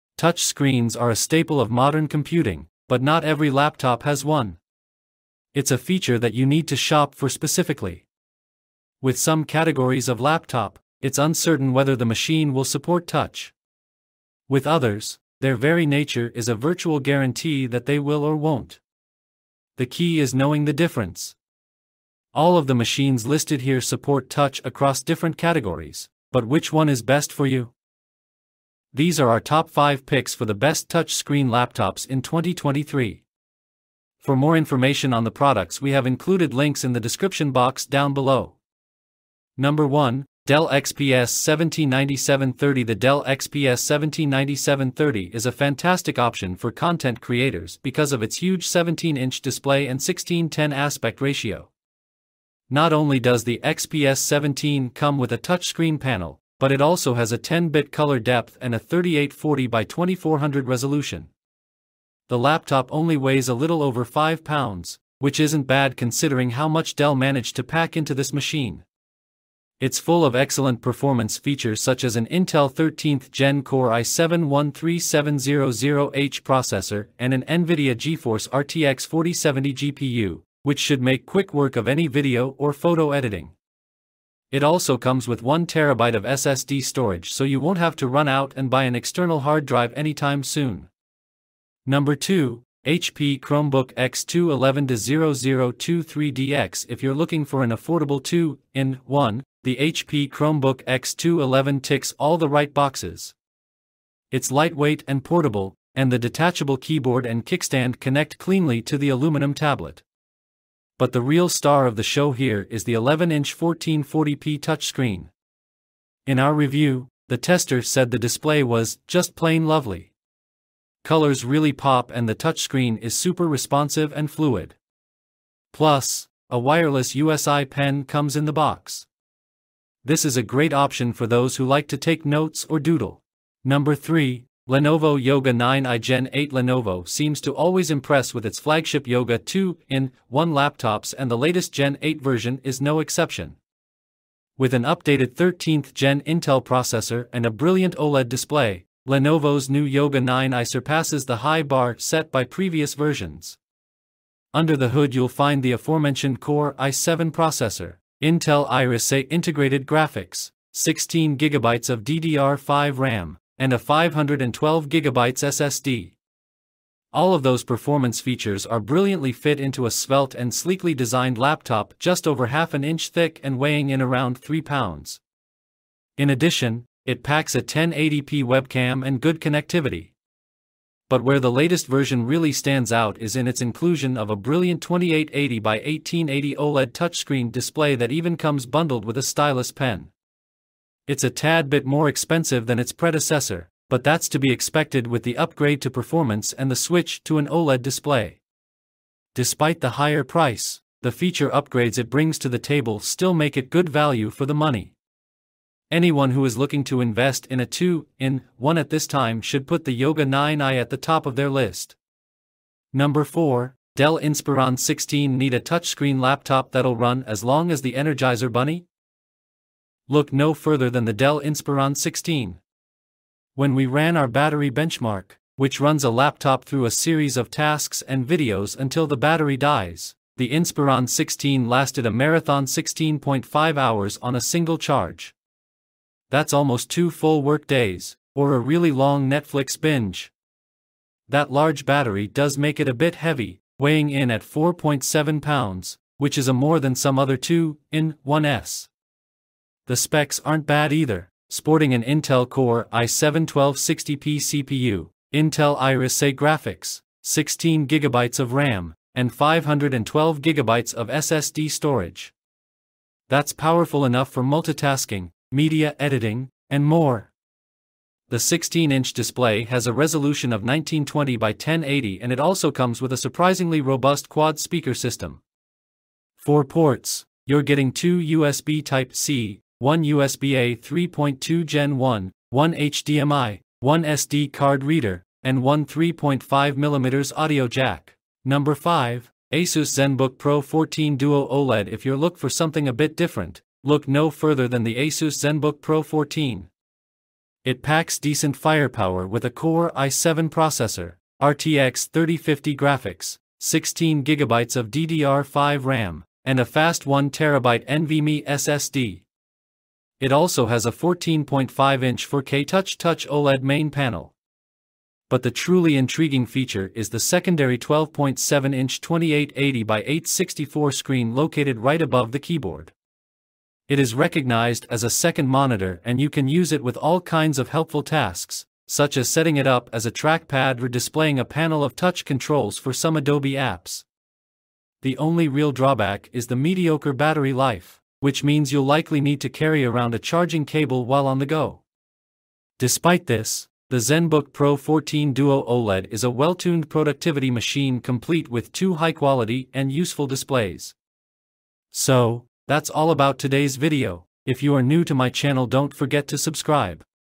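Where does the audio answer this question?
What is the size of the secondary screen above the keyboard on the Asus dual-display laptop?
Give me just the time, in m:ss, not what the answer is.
5:17.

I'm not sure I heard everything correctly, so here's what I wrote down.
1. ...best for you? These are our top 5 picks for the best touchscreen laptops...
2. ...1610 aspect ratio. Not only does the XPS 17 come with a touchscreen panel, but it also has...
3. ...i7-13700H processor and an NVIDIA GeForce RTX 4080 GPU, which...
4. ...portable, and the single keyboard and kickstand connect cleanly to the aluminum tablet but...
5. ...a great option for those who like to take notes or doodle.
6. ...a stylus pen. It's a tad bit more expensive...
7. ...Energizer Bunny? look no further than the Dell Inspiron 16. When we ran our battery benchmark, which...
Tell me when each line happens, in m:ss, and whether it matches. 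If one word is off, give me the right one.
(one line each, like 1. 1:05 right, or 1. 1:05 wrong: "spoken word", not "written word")
1. 0:27 right
2. 0:50 right
3. 1:13 wrong: "4070", not "4080"
4. 1:45 wrong: "detachable", not "single"
5. 2:10 right
6. 3:09 right
7. 3:37 right.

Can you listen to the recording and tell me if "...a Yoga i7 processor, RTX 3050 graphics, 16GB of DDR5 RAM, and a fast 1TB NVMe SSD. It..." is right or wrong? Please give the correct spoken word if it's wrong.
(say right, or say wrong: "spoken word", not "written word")
wrong: "Core", not "Yoga".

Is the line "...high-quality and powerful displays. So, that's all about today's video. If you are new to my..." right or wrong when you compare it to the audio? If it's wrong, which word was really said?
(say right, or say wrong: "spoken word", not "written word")
wrong: "useful", not "powerful".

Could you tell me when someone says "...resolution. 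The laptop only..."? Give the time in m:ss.
1:00.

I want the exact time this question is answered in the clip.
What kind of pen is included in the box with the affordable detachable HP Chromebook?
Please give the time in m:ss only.
2:06.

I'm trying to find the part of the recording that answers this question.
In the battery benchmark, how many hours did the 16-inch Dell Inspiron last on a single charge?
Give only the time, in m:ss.
3:52.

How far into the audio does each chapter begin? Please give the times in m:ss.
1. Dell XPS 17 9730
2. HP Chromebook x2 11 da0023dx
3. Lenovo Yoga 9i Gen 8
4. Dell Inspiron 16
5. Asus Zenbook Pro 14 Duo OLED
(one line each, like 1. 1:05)
1. 0:41
2. 1:34
3. 2:14
4. 3:35
5. 4:50.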